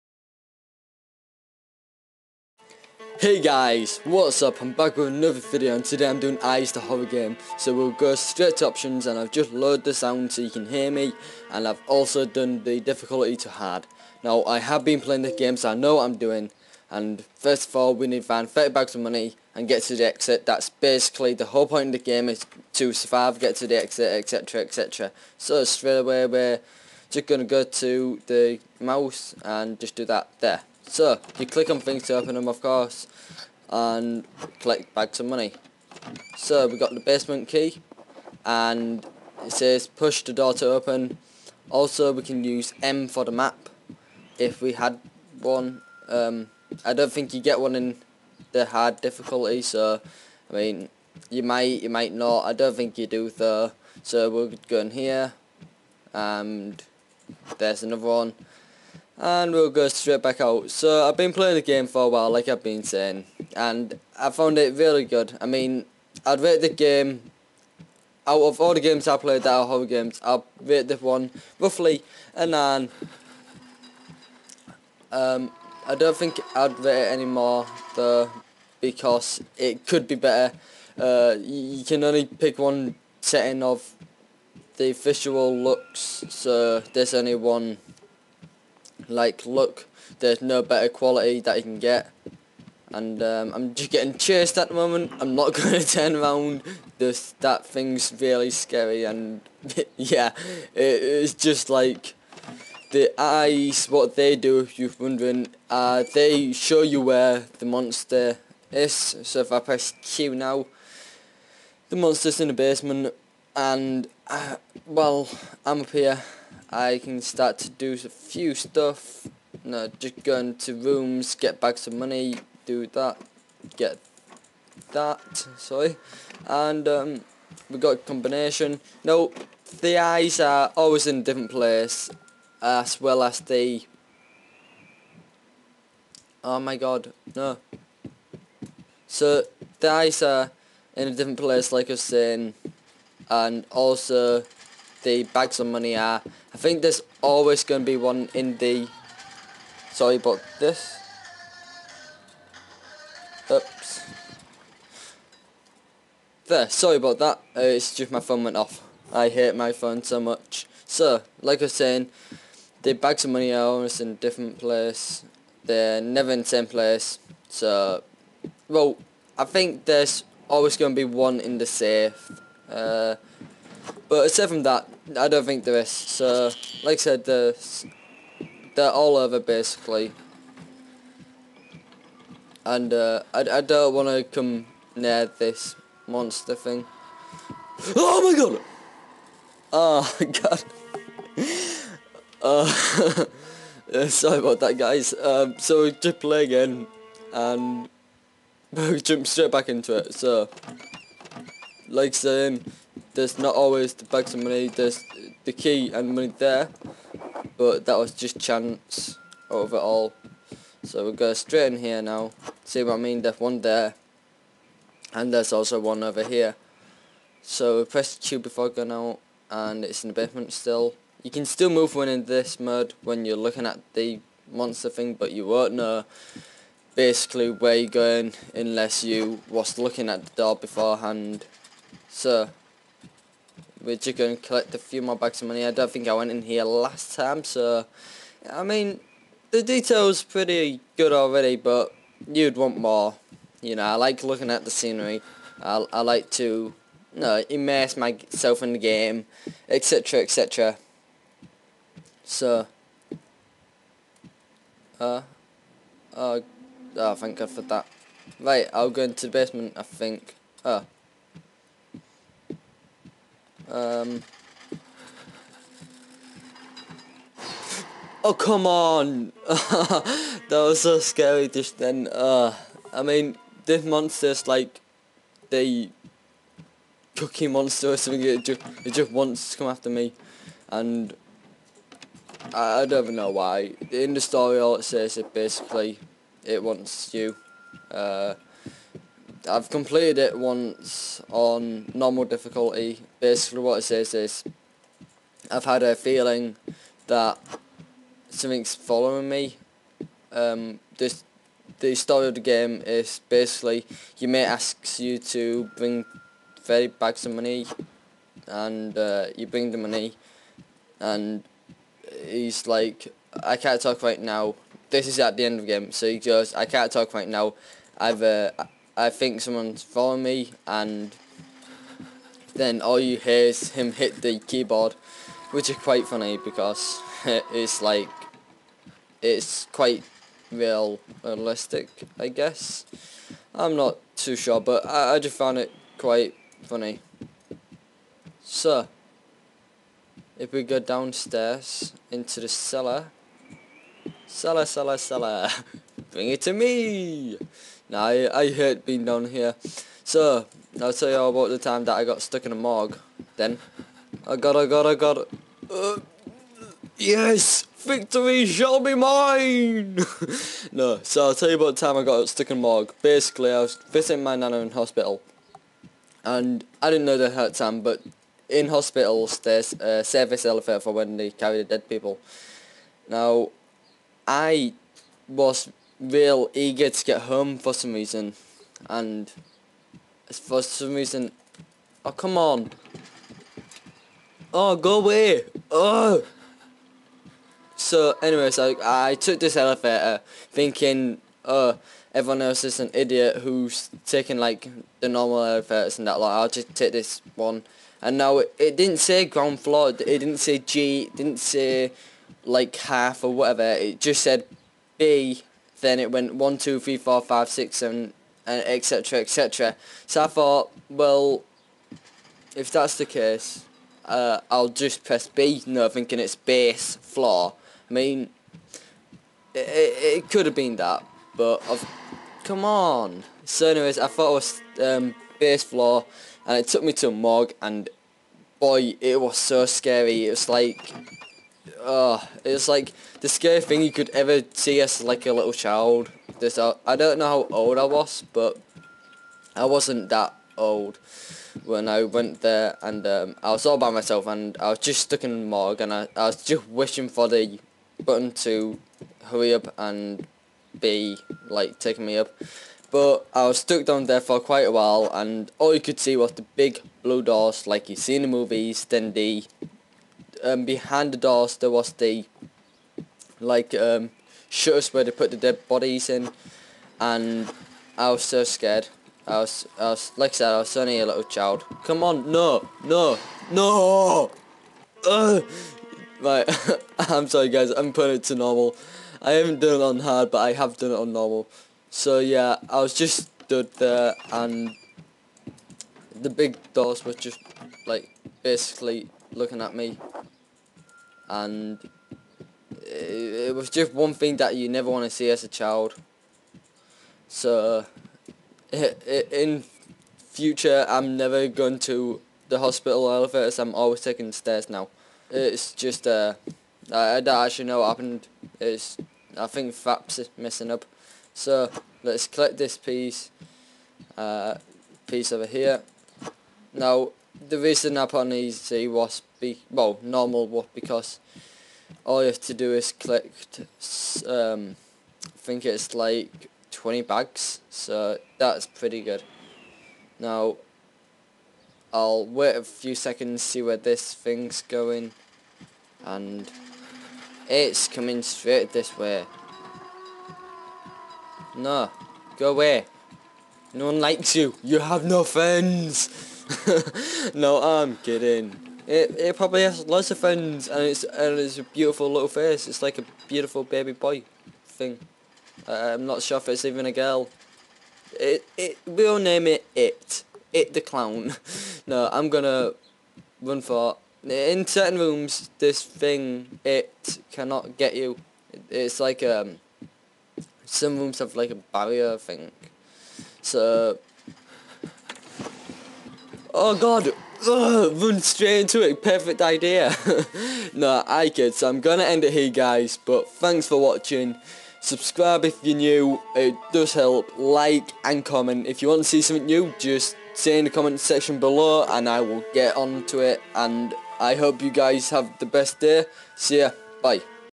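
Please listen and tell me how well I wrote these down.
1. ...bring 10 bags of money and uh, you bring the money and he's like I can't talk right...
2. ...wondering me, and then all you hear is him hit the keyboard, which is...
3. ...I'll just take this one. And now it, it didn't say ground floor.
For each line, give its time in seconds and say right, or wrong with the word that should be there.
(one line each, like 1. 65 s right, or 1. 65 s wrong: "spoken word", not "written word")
1. 305 s wrong: "30", not "10"
2. 319 s wrong: "following", not "wondering"
3. 396 s right.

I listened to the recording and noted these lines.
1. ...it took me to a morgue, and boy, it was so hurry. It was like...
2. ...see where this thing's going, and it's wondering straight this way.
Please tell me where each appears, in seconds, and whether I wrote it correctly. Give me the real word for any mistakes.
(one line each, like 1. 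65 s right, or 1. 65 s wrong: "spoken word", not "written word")
1. 426 s wrong: "scary", not "hurry"
2. 533 s wrong: "coming", not "wondering".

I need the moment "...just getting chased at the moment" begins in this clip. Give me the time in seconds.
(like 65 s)
93 s.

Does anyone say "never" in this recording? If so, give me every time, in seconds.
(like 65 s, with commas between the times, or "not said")
166 s, 494 s, 501 s.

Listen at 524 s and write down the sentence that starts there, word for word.
Um, I think it's like 20 bags, so that's pretty good.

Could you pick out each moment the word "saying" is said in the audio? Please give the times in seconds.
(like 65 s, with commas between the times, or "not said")
62 s, 142 s, 161 s, 202 s.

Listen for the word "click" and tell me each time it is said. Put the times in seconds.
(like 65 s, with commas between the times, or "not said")
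31 s, 522 s.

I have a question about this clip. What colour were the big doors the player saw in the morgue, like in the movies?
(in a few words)
blue.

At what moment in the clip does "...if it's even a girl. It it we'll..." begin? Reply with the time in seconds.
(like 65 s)
556 s.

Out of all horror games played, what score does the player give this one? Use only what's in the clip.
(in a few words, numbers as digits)
9.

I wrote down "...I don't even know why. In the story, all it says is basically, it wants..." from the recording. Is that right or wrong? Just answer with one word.
right.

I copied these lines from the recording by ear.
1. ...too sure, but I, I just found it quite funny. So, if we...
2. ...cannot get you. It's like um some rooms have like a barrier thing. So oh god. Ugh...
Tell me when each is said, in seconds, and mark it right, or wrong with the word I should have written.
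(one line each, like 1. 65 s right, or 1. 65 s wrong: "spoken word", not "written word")
1. 334 s right
2. 567 s right.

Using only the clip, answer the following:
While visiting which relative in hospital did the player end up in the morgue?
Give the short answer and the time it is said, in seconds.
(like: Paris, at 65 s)
nana, at 364 s.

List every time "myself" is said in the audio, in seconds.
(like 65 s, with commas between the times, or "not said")
247 s, 443 s.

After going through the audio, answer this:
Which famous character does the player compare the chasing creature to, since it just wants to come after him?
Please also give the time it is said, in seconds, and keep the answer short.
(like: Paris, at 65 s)
Cookie Monster, at 277 s.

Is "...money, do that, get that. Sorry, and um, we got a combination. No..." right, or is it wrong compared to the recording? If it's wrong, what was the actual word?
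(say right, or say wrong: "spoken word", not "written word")
right.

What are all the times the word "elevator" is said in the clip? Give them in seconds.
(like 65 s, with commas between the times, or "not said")
370 s, 389 s, 395 s, 503 s.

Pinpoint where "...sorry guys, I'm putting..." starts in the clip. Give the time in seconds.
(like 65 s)
477 s.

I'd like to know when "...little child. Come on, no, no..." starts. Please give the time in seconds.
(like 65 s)
471 s.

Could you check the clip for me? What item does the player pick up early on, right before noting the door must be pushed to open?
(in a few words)
basement key.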